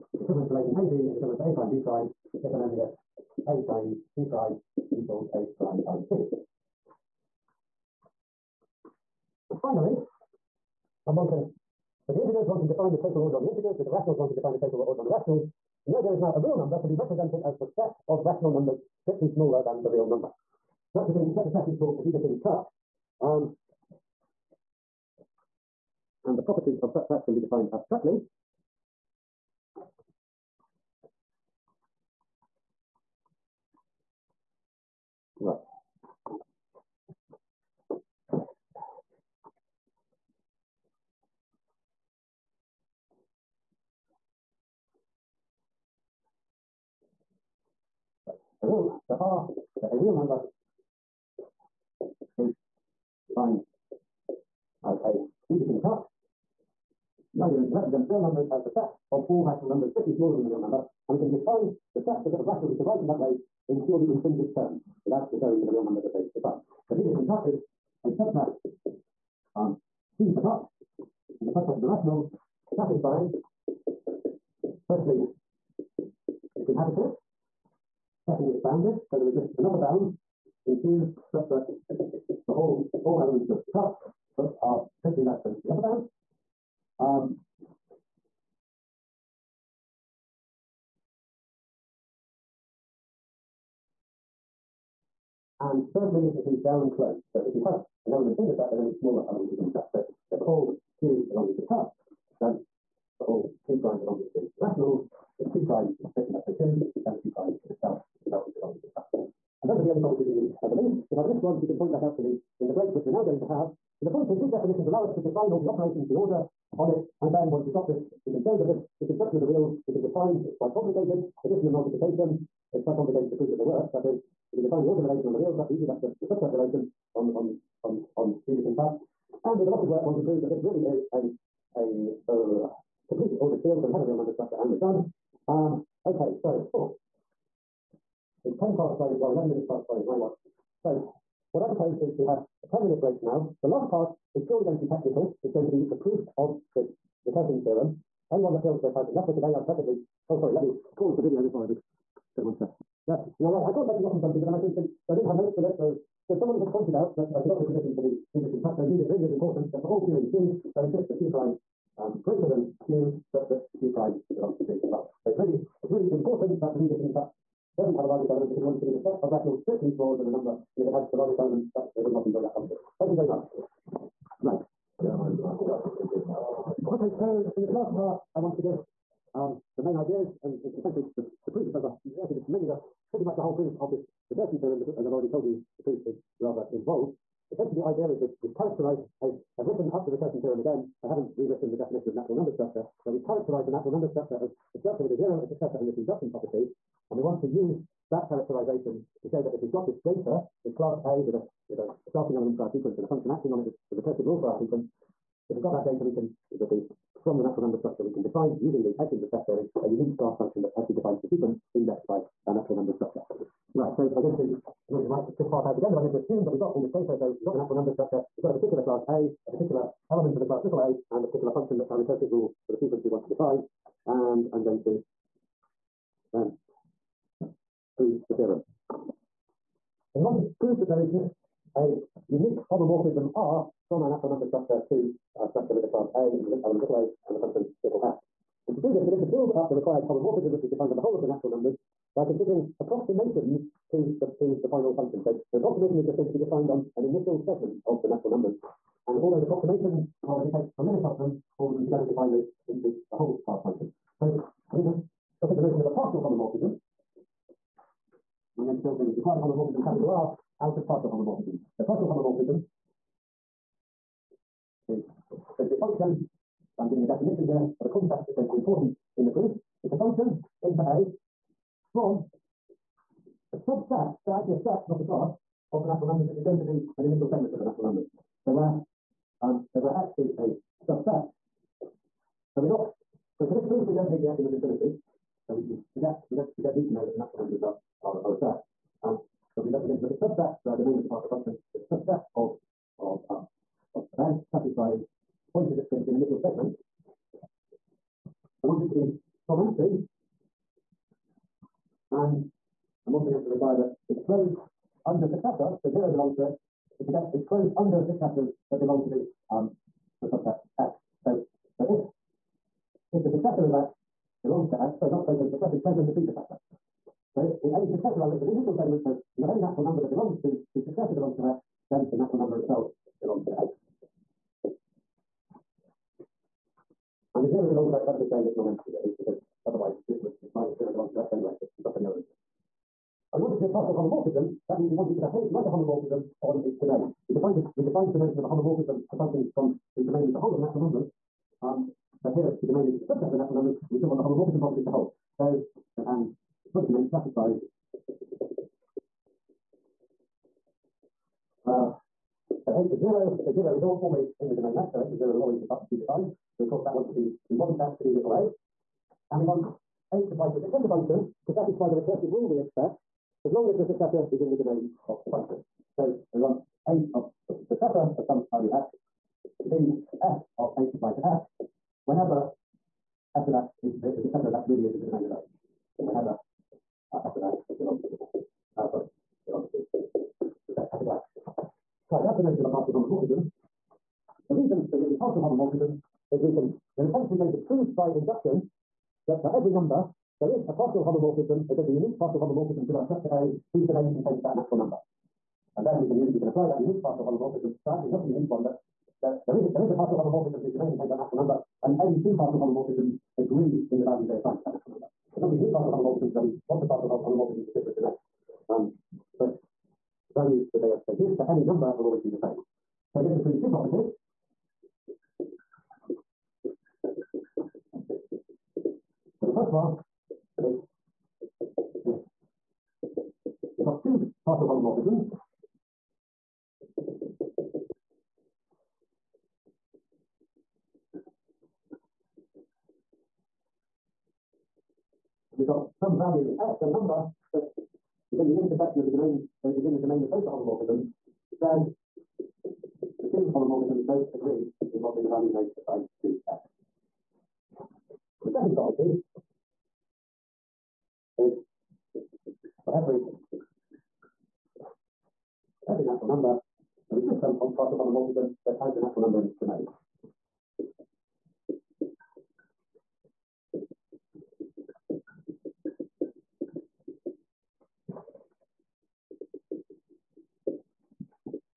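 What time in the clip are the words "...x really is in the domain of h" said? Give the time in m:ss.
6:14.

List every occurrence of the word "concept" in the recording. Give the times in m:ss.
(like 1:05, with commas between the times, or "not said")
4:27.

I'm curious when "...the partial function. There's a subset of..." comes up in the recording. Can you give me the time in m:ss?
4:51.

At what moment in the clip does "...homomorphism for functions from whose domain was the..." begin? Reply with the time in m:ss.
5:38.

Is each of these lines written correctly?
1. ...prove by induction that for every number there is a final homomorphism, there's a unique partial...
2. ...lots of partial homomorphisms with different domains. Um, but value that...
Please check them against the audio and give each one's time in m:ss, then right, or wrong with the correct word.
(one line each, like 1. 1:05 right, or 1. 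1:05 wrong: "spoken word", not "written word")
1. 6:27 wrong: "partial", not "final"
2. 6:46 right.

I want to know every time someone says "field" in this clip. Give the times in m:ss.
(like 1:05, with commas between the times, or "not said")
2:13.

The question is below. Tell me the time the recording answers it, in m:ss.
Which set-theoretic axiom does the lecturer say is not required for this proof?
4:44.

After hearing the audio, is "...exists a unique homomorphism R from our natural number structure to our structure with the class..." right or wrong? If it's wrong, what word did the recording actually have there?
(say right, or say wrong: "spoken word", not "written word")
right.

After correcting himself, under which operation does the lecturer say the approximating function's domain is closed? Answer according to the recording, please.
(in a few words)
predecessor.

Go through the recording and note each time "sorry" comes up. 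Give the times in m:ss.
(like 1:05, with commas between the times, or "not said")
2:30, 5:14, 6:18.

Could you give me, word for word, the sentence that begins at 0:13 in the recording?
With the rationals, one can define the total order on the rationals.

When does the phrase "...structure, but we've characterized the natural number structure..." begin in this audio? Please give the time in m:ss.
3:12.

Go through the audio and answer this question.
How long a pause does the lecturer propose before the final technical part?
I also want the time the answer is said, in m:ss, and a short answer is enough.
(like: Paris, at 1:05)
10 minutes, at 2:22.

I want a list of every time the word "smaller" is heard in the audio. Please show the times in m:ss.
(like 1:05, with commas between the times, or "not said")
0:19, 1:00, 1:38, 2:49.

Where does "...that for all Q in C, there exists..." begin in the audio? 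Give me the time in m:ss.
2:39.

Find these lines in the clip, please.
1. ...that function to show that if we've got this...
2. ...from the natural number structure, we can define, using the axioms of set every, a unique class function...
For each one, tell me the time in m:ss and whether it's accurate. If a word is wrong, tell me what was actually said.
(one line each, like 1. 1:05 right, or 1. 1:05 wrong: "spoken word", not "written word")
1. 3:18 wrong: "characterization", not "function"
2. 3:27 wrong: "theory", not "every".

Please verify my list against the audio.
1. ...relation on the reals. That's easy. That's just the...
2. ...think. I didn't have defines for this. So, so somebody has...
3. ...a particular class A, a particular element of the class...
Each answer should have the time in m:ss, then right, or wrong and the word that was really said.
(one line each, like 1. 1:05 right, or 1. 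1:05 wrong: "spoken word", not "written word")
1. 2:05 right
2. 2:34 wrong: "notes", not "defines"
3. 3:38 right.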